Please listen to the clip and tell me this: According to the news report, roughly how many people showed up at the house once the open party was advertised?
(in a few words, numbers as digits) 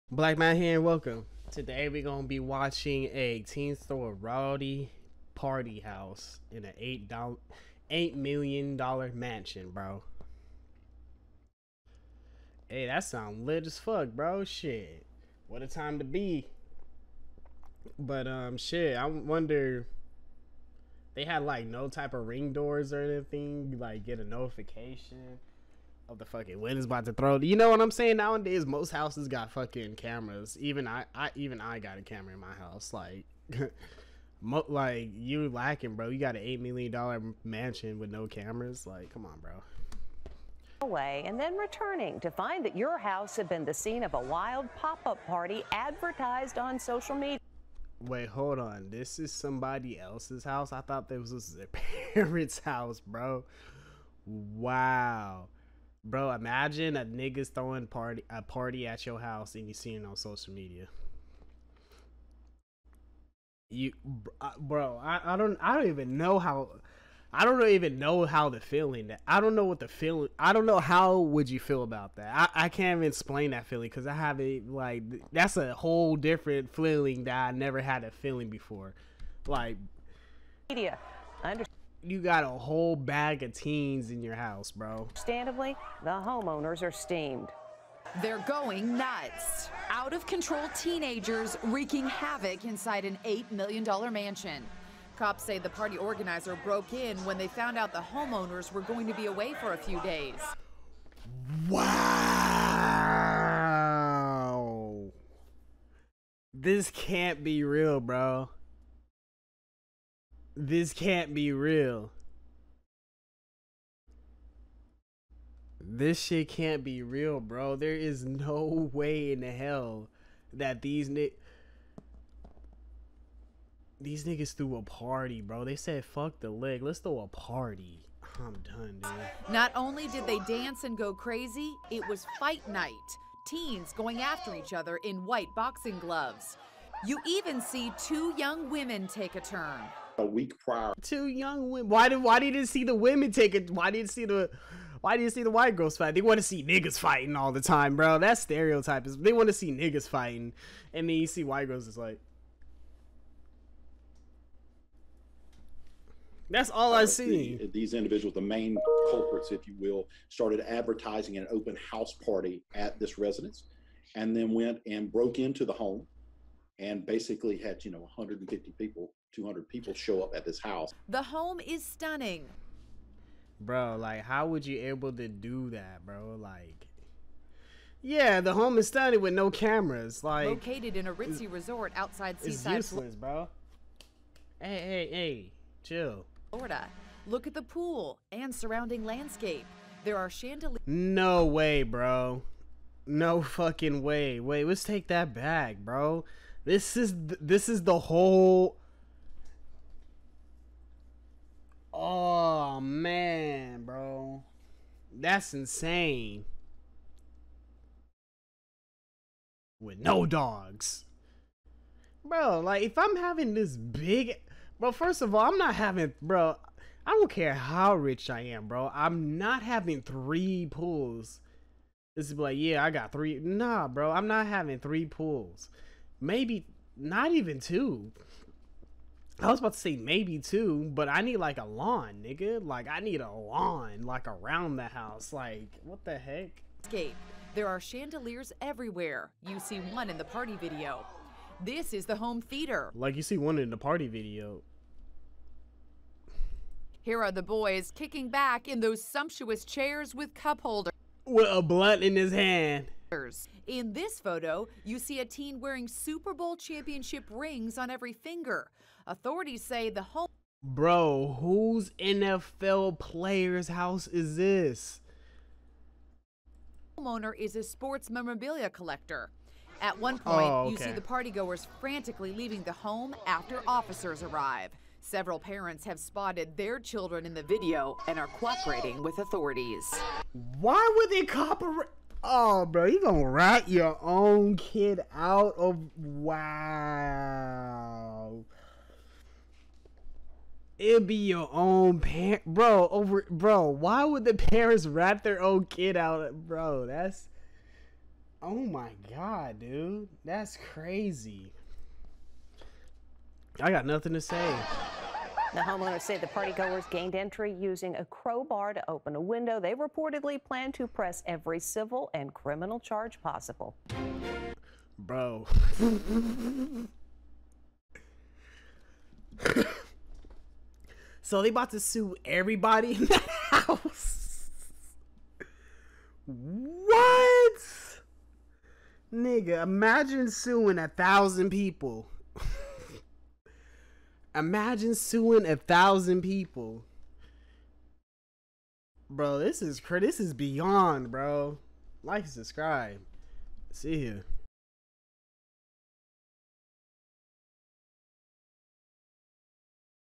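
150 to 200.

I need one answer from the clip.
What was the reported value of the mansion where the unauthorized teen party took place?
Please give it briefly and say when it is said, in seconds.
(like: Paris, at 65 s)
$8 million, at 93 s.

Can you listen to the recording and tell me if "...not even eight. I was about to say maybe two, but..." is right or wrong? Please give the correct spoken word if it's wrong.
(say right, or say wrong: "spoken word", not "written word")
wrong: "two", not "eight".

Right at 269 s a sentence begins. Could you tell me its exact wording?
At one oh, point, oh, okay.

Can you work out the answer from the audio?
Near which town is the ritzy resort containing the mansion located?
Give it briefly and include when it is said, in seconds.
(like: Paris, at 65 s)
Seaside, at 182 s.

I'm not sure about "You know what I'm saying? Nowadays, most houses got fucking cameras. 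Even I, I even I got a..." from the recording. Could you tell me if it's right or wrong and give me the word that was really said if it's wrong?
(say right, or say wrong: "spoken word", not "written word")
right.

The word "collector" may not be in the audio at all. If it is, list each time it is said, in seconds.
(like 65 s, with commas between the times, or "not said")
268 s.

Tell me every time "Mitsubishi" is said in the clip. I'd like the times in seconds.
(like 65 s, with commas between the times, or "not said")
not said.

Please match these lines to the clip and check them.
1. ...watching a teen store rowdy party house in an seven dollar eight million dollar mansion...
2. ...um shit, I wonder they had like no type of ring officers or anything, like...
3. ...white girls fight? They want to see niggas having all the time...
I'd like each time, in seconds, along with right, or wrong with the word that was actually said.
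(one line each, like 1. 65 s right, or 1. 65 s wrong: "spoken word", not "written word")
1. 2 s wrong: "eight", not "seven"
2. 18 s wrong: "doors", not "officers"
3. 145 s wrong: "fighting", not "having".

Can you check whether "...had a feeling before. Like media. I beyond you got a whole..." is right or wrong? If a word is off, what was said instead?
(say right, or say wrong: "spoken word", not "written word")
wrong: "understand", not "beyond".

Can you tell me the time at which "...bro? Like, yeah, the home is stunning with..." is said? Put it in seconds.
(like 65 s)
176 s.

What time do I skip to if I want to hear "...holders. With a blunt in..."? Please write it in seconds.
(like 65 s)
250 s.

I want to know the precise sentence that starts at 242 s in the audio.
Like you see one in the party video.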